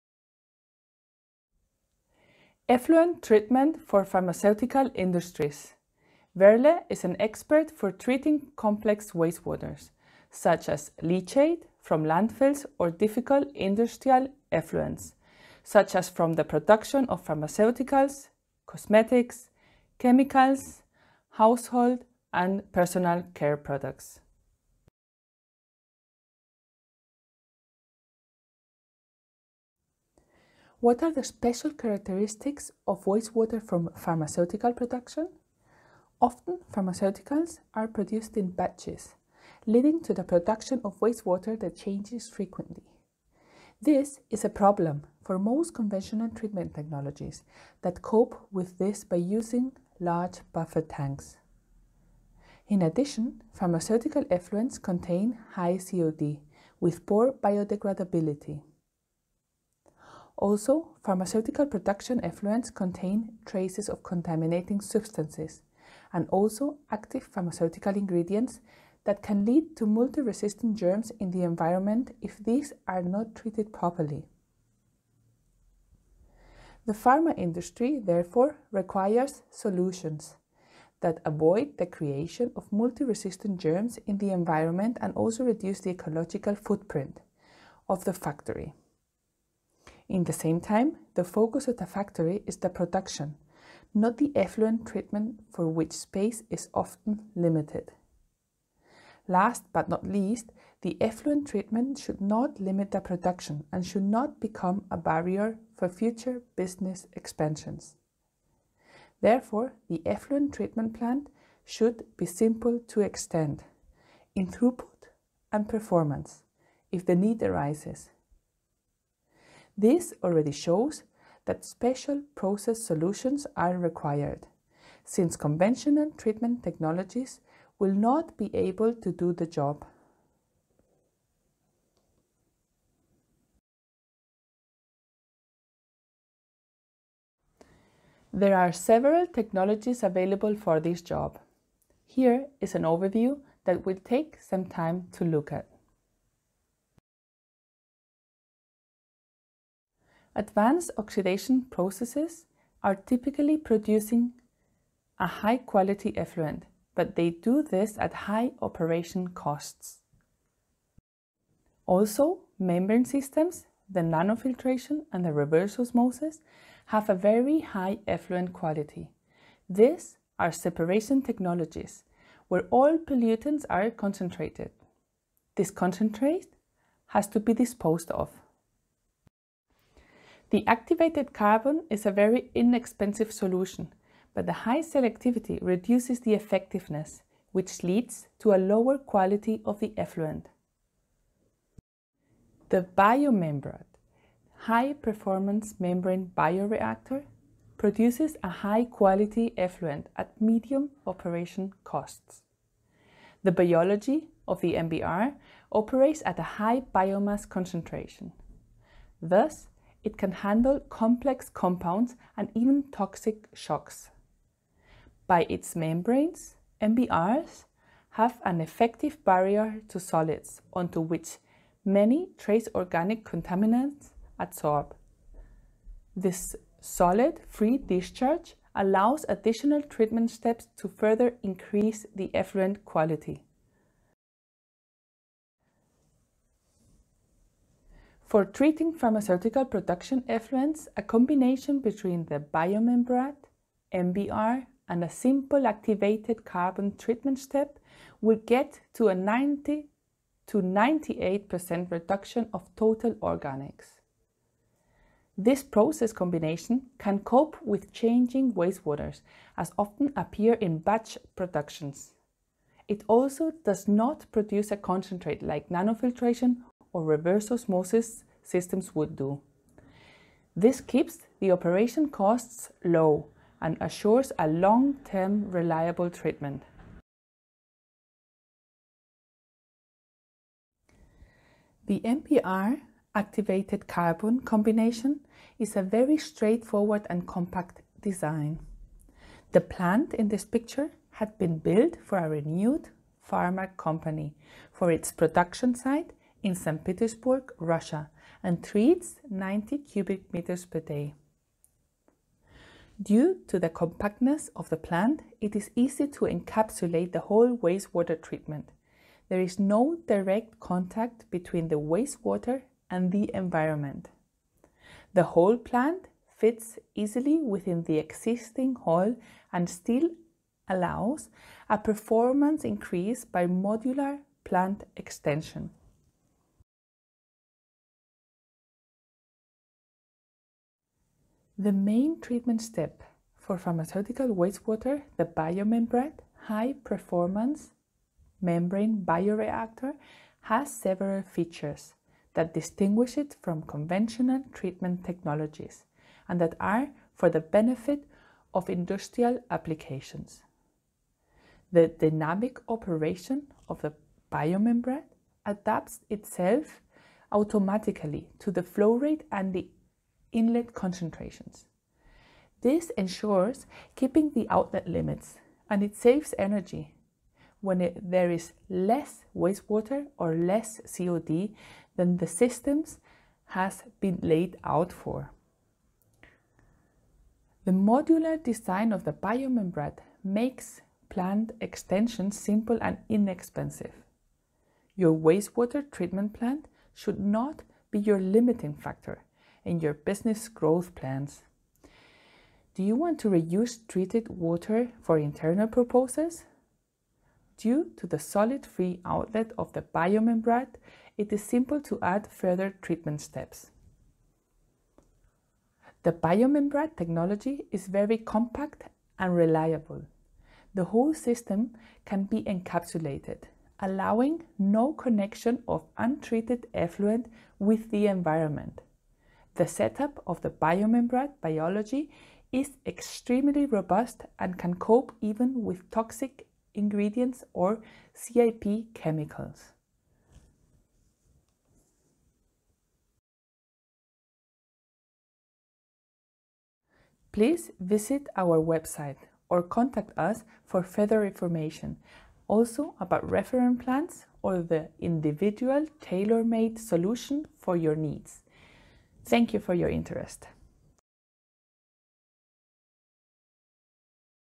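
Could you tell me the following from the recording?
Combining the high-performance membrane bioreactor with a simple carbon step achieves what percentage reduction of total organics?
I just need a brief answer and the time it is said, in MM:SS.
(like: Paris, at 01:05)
90 to 98%, at 04:09.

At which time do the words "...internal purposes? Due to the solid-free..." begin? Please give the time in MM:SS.
06:35.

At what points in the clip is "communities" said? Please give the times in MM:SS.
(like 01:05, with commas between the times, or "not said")
not said.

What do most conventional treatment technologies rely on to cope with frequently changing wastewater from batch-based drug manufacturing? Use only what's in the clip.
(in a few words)
Large buffer tanks.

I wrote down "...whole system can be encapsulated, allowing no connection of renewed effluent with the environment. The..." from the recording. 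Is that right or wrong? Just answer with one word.
wrong.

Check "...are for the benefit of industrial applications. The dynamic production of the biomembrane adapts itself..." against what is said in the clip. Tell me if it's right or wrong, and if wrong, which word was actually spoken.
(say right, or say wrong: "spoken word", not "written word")
wrong: "operation", not "production".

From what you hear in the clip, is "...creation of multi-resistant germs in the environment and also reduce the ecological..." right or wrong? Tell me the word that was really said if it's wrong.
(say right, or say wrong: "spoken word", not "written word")
right.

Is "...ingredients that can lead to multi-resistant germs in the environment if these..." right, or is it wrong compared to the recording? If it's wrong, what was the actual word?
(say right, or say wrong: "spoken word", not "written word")
right.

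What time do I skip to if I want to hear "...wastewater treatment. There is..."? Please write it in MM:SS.
05:07.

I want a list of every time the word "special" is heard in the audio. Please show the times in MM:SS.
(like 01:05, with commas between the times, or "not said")
00:31, 02:01.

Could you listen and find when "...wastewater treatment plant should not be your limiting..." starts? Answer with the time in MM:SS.
06:25.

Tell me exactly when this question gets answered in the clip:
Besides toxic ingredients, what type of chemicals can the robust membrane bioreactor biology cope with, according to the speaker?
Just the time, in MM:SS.
07:08.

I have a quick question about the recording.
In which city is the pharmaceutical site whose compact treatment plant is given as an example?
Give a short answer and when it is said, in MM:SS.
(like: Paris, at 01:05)
St. Petersburg, at 04:56.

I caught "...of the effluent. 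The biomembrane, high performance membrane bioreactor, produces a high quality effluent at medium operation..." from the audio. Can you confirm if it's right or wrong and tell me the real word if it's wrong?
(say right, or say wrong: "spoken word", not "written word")
right.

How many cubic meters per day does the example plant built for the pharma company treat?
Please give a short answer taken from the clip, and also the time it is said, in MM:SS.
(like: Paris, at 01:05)
90, at 04:59.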